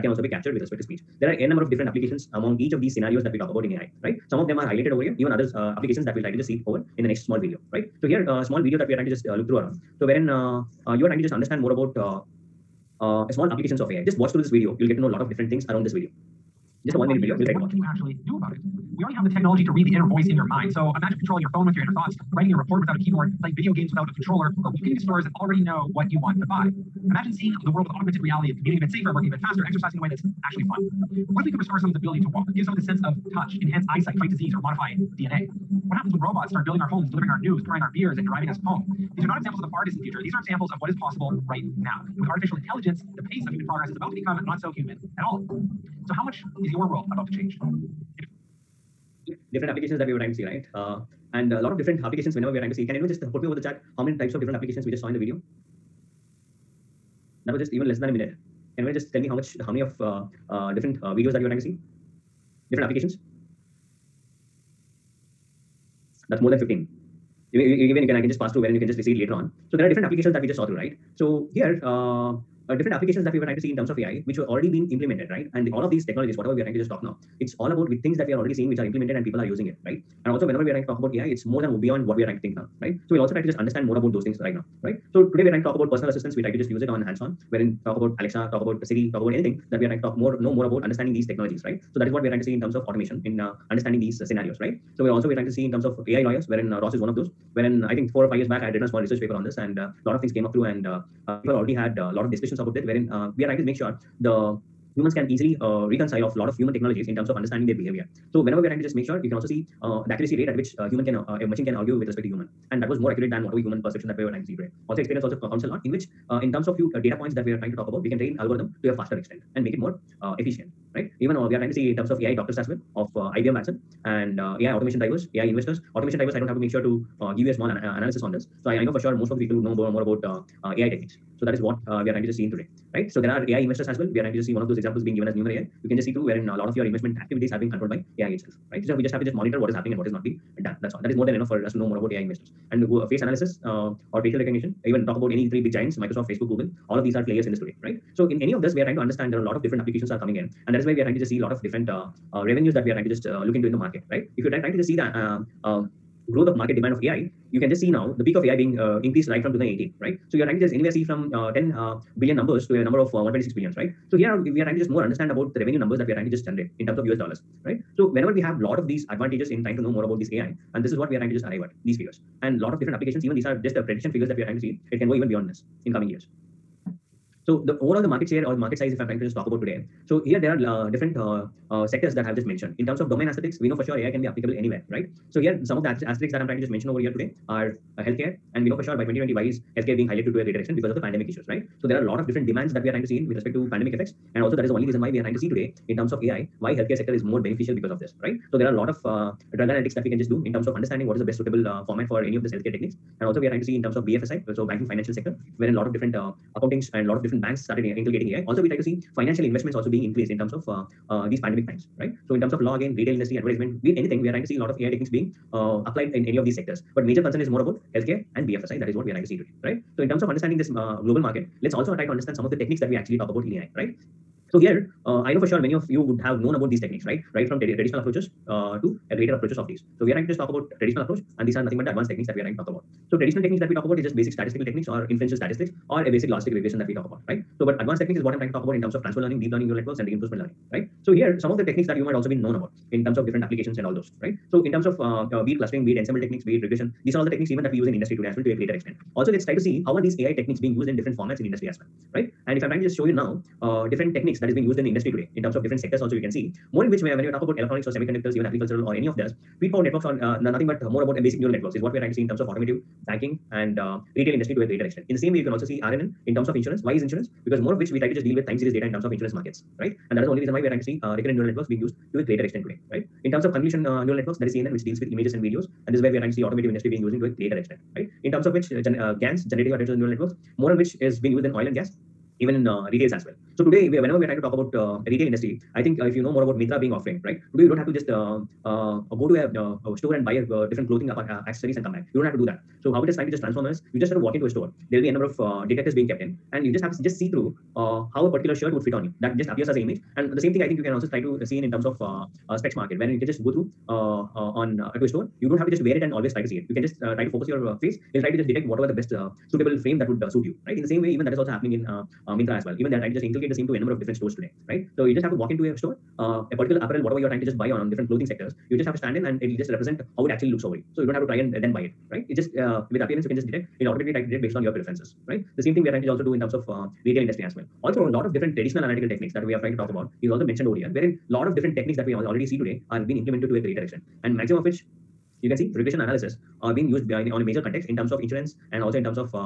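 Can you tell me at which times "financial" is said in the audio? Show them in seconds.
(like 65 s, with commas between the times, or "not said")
204 s, 209 s.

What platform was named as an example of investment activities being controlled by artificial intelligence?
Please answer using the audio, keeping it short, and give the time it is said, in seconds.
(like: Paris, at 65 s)
Numerai, at 135 s.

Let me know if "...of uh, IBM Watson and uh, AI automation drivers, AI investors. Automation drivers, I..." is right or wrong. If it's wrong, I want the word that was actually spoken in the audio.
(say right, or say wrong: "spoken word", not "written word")
right.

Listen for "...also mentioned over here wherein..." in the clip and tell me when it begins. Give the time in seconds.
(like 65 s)
330 s.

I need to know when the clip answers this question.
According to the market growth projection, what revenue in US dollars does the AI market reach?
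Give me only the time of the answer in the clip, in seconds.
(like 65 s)
163 s.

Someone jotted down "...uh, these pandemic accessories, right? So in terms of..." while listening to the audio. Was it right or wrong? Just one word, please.
wrong.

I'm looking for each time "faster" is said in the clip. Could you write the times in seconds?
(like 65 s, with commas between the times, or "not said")
29 s, 118 s.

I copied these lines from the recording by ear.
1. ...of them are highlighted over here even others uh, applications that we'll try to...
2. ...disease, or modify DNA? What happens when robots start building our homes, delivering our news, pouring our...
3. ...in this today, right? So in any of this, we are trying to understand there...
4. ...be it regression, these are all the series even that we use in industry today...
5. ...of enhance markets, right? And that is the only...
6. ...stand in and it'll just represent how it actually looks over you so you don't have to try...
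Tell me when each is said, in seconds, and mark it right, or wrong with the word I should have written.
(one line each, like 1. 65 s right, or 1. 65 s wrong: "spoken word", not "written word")
1. 4 s right
2. 34 s right
3. 147 s right
4. 246 s wrong: "techniques", not "series"
5. 269 s wrong: "insurance", not "enhance"
6. 318 s right.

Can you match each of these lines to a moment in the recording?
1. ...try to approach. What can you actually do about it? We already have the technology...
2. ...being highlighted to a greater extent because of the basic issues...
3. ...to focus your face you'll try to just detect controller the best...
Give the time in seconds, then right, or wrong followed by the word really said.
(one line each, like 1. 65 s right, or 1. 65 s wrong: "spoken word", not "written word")
1. 17 s wrong: "watch", not "approach"
2. 189 s wrong: "pandemic", not "basic"
3. 307 s wrong: "whatever", not "controller".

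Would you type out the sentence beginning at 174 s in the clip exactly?
It can go even beyond this in coming years.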